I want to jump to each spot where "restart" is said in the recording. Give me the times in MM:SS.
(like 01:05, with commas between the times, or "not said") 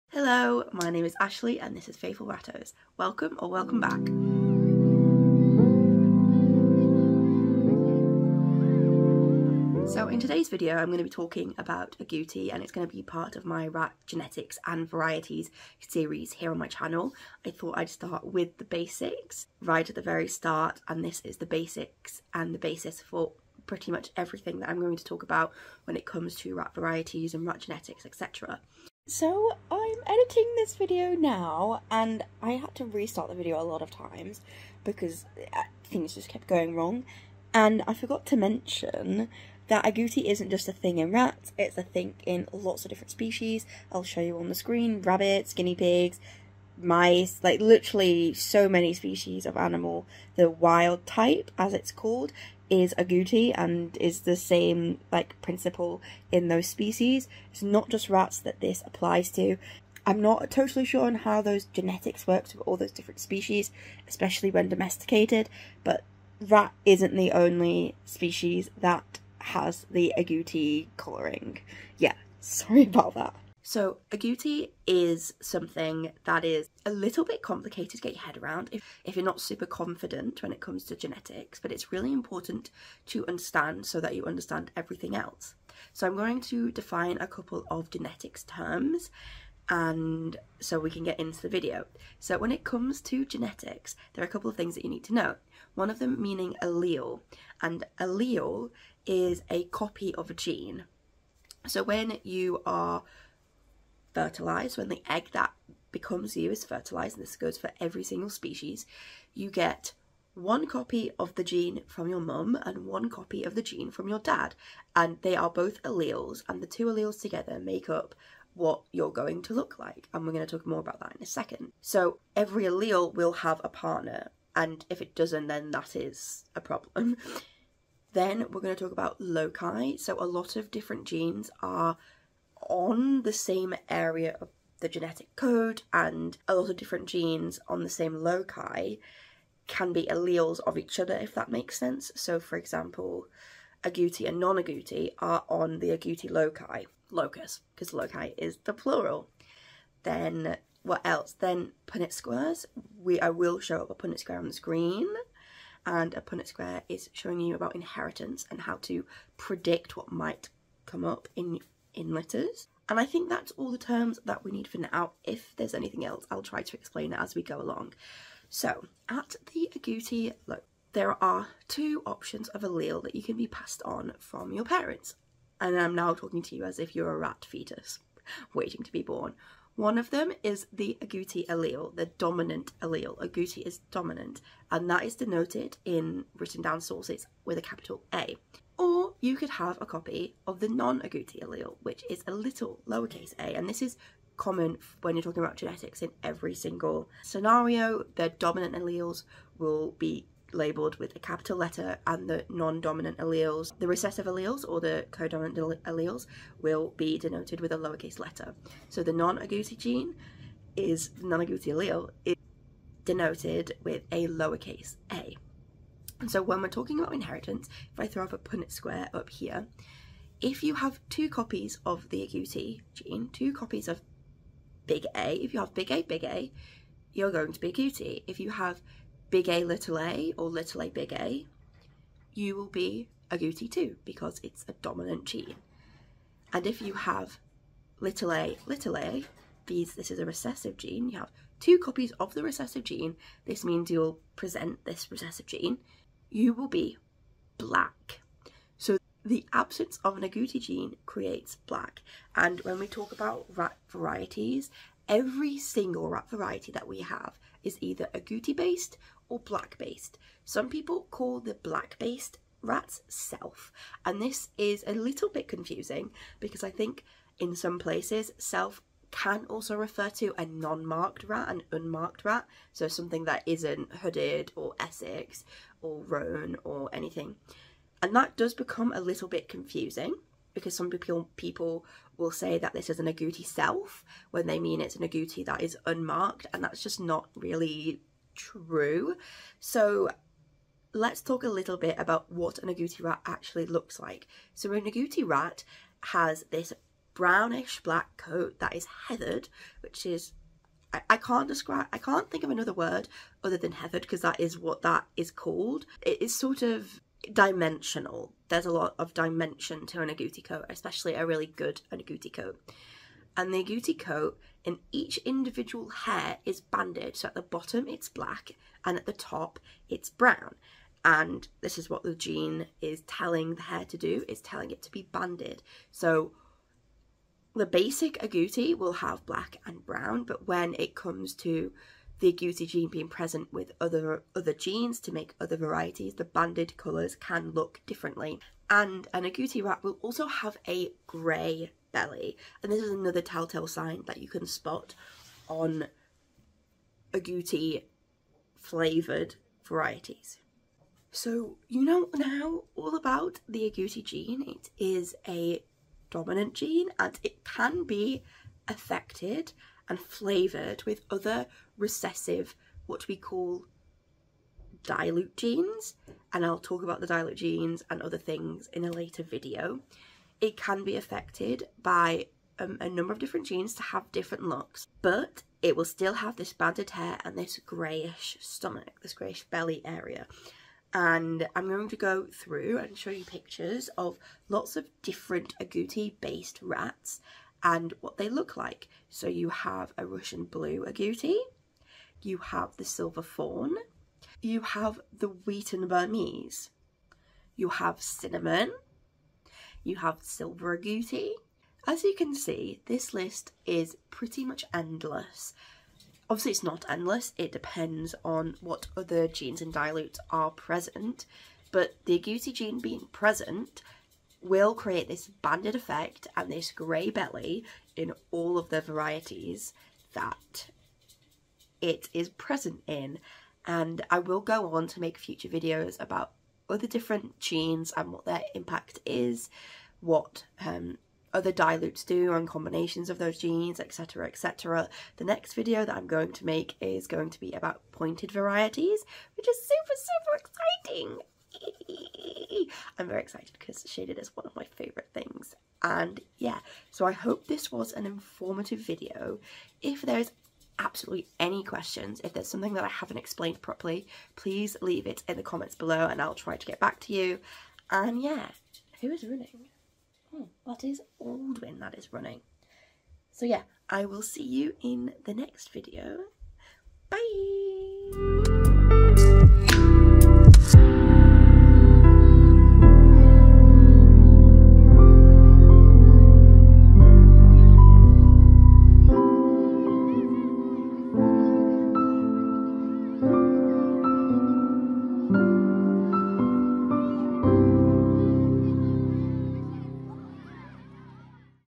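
00:32.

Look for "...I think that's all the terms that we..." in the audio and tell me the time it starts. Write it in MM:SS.
02:42.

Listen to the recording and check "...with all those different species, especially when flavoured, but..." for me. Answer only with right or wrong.
wrong.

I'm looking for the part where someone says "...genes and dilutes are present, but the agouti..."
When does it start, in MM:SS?
06:49.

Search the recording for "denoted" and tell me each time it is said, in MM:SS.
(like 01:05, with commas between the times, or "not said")
03:05, 03:27, 03:33.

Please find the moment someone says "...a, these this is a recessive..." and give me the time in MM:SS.
03:58.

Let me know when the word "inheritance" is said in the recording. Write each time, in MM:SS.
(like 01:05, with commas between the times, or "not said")
02:37, 03:37.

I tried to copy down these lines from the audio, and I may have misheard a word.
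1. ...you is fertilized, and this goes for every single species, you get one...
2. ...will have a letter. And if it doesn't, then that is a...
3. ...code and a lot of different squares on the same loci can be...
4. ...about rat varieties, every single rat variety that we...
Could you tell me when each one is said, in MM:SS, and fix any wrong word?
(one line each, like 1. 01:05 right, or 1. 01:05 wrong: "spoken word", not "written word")
1. 01:46 right
2. 02:03 wrong: "partner", not "letter"
3. 02:15 wrong: "genes", not "squares"
4. 04:13 right.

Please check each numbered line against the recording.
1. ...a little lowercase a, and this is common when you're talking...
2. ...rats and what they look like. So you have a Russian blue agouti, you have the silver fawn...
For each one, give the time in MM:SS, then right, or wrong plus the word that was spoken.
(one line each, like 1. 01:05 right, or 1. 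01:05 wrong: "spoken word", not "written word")
1. 03:12 right
2. 06:26 right.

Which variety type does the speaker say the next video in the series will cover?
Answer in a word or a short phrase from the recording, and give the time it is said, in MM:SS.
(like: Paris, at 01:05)
pointed varieties, at 07:17.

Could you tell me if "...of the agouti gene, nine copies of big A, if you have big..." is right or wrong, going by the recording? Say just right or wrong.
wrong.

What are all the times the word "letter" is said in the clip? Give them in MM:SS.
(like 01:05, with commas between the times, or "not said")
02:42, 03:21, 03:28.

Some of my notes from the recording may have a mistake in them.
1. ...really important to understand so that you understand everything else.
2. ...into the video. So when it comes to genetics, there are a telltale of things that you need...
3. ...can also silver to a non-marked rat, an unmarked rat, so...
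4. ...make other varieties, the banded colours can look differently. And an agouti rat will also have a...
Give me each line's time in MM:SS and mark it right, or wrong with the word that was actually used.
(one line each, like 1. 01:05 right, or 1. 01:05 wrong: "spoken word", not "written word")
1. 01:21 right
2. 01:31 wrong: "couple", not "telltale"
3. 04:29 wrong: "refer", not "silver"
4. 05:35 right.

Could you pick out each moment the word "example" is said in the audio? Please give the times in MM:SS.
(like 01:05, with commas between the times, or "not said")
02:22.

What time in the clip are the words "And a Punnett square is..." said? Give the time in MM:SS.
02:35.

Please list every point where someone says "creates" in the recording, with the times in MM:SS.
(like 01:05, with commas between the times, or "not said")
04:11, 06:54.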